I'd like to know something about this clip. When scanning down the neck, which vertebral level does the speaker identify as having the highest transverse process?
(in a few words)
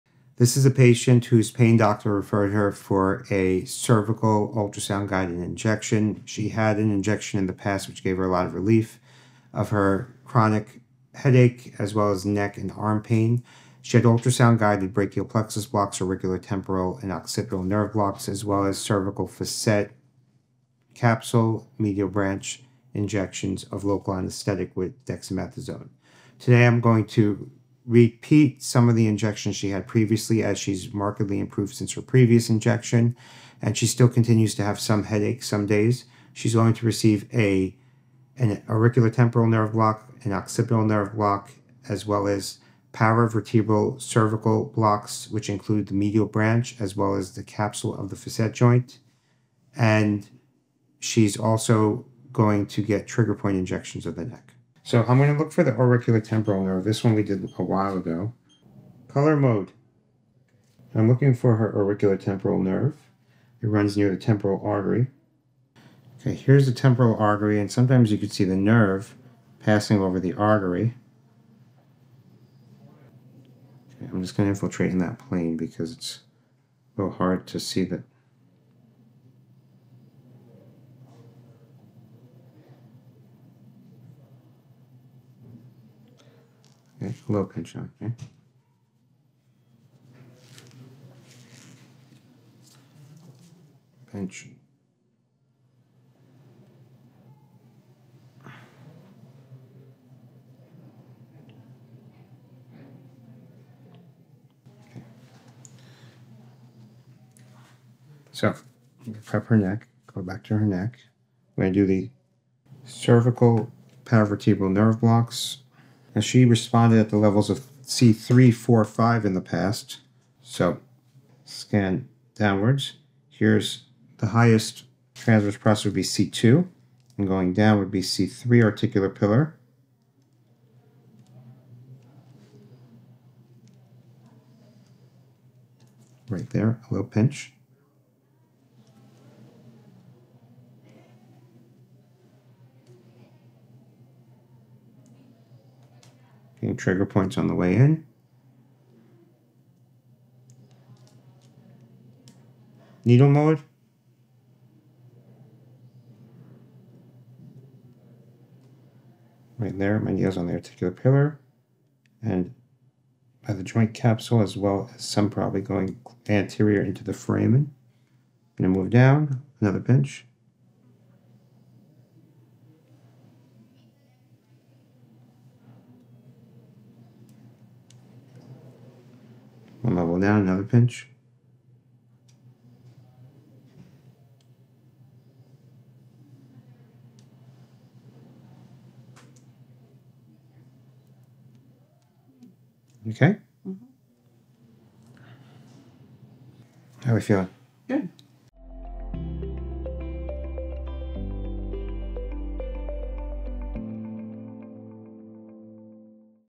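C2.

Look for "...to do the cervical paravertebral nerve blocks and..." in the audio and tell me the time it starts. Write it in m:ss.
1:51.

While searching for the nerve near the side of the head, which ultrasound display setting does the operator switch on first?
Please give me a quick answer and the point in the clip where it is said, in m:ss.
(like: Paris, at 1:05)
Color mode, at 0:59.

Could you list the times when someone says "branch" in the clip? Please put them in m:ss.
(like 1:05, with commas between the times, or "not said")
0:22, 0:46.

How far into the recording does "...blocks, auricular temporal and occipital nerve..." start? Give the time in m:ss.
0:15.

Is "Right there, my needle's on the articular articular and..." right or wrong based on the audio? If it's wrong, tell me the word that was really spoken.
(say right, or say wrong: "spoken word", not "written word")
wrong: "pillar", not "articular".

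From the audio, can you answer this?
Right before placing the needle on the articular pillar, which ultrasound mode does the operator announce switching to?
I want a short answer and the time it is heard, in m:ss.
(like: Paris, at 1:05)
Needle mode, at 2:33.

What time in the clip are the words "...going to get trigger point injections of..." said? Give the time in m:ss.
0:52.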